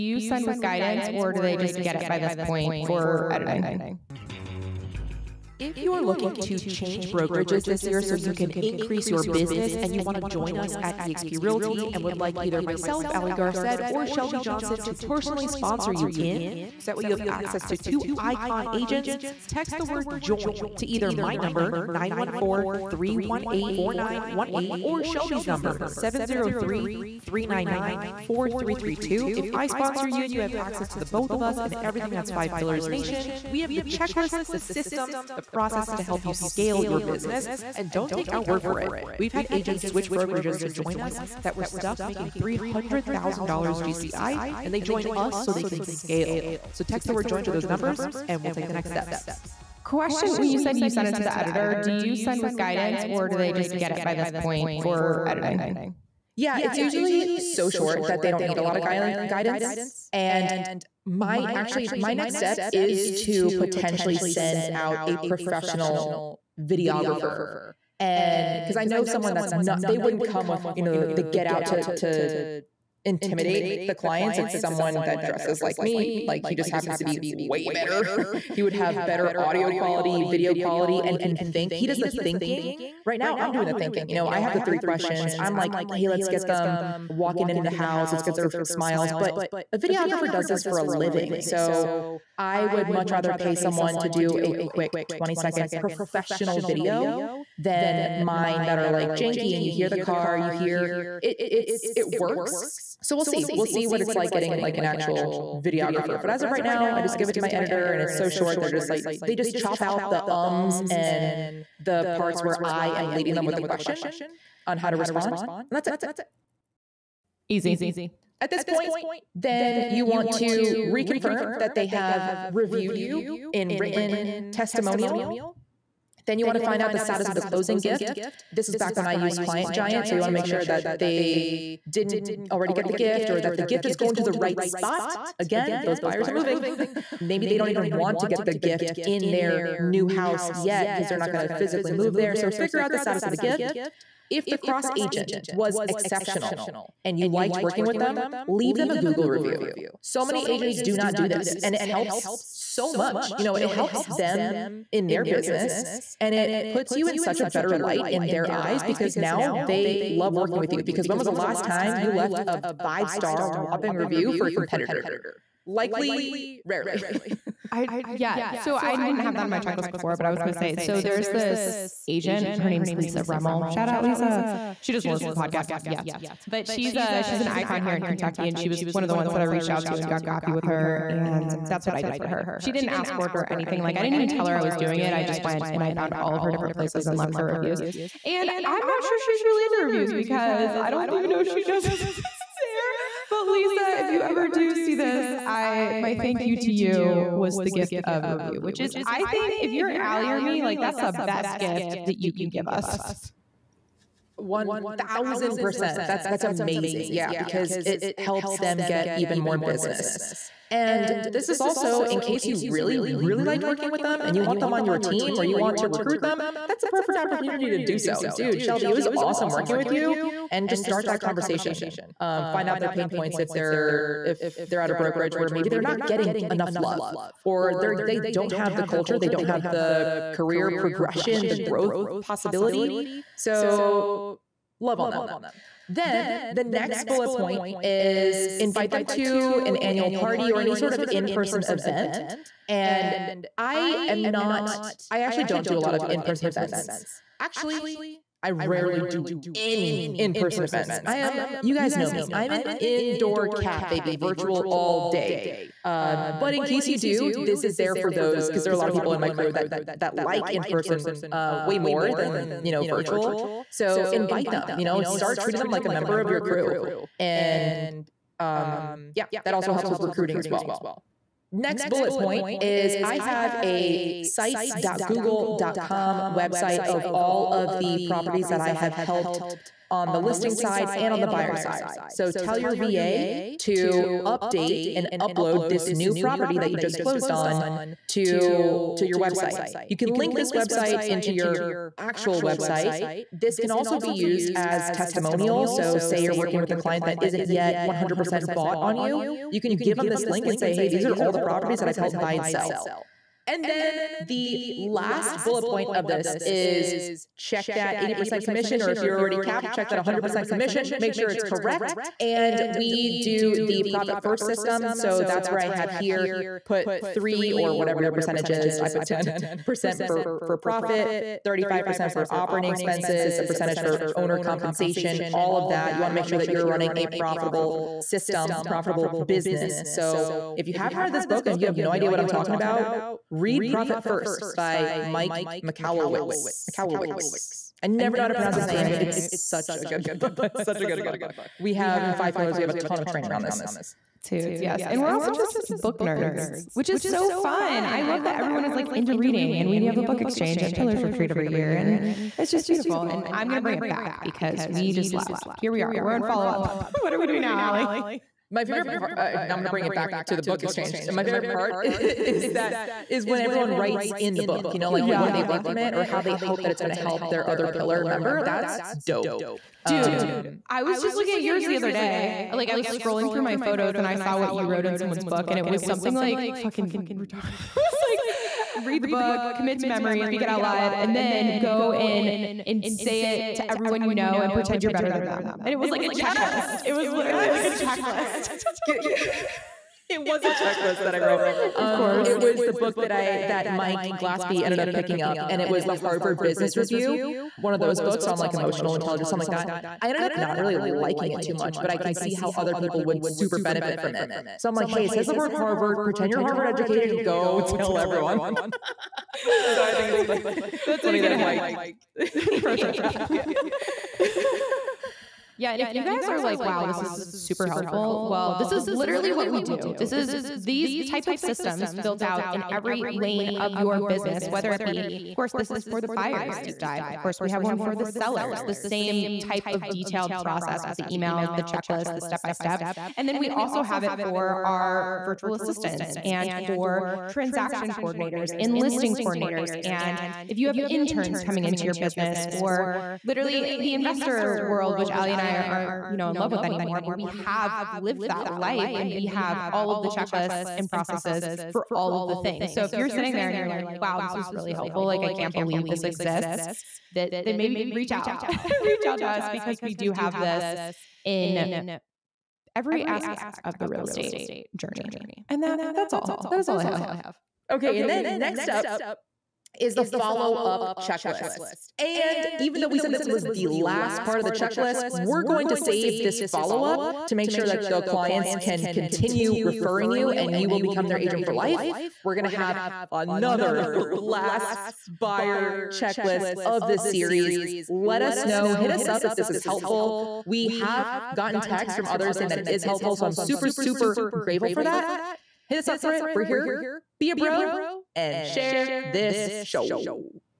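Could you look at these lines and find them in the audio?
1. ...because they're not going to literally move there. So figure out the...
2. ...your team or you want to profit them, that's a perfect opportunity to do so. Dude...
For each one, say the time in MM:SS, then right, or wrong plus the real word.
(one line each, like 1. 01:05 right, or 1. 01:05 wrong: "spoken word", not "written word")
1. 02:20 wrong: "physically", not "literally"
2. 03:34 wrong: "recruit", not "profit".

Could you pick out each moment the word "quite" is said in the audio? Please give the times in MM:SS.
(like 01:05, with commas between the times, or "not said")
not said.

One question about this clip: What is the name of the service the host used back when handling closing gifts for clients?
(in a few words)
Client Giant.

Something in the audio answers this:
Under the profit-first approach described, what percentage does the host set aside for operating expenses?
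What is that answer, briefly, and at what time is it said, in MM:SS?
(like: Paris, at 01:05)
35%, at 05:21.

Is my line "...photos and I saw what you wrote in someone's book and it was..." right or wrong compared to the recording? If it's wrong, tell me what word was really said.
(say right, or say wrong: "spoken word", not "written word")
right.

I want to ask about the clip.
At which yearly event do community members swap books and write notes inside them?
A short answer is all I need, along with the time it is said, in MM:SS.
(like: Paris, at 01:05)
Pillars Retreat, at 05:50.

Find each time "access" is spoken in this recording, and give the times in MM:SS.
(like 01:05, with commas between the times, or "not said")
00:17, 00:30.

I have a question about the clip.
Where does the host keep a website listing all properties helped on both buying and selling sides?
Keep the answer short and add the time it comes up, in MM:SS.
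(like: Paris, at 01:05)
sites.google.com, at 04:34.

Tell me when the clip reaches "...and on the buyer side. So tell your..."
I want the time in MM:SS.
04:40.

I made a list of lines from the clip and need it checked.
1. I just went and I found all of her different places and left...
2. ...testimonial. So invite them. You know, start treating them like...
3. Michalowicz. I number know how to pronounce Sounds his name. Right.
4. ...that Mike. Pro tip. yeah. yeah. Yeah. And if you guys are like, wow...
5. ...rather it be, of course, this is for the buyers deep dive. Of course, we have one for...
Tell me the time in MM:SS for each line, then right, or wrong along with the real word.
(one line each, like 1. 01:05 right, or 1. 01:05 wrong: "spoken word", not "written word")
1. 03:05 right
2. 04:22 wrong: "virtual", not "testimonial"
3. 05:36 wrong: "never", not "number"
4. 06:51 right
5. 07:04 wrong: "whether", not "rather".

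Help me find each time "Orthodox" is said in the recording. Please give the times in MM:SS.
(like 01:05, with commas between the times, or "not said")
not said.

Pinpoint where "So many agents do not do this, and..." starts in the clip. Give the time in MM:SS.
02:30.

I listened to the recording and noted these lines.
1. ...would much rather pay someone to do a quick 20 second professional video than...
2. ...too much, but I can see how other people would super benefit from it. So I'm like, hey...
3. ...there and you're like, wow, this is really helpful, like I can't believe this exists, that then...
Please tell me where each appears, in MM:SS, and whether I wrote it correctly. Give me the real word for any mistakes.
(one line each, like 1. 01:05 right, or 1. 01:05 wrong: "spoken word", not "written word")
1. 01:32 right
2. 06:41 right
3. 07:33 right.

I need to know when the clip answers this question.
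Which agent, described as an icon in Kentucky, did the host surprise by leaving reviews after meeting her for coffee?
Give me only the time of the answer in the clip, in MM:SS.
02:52.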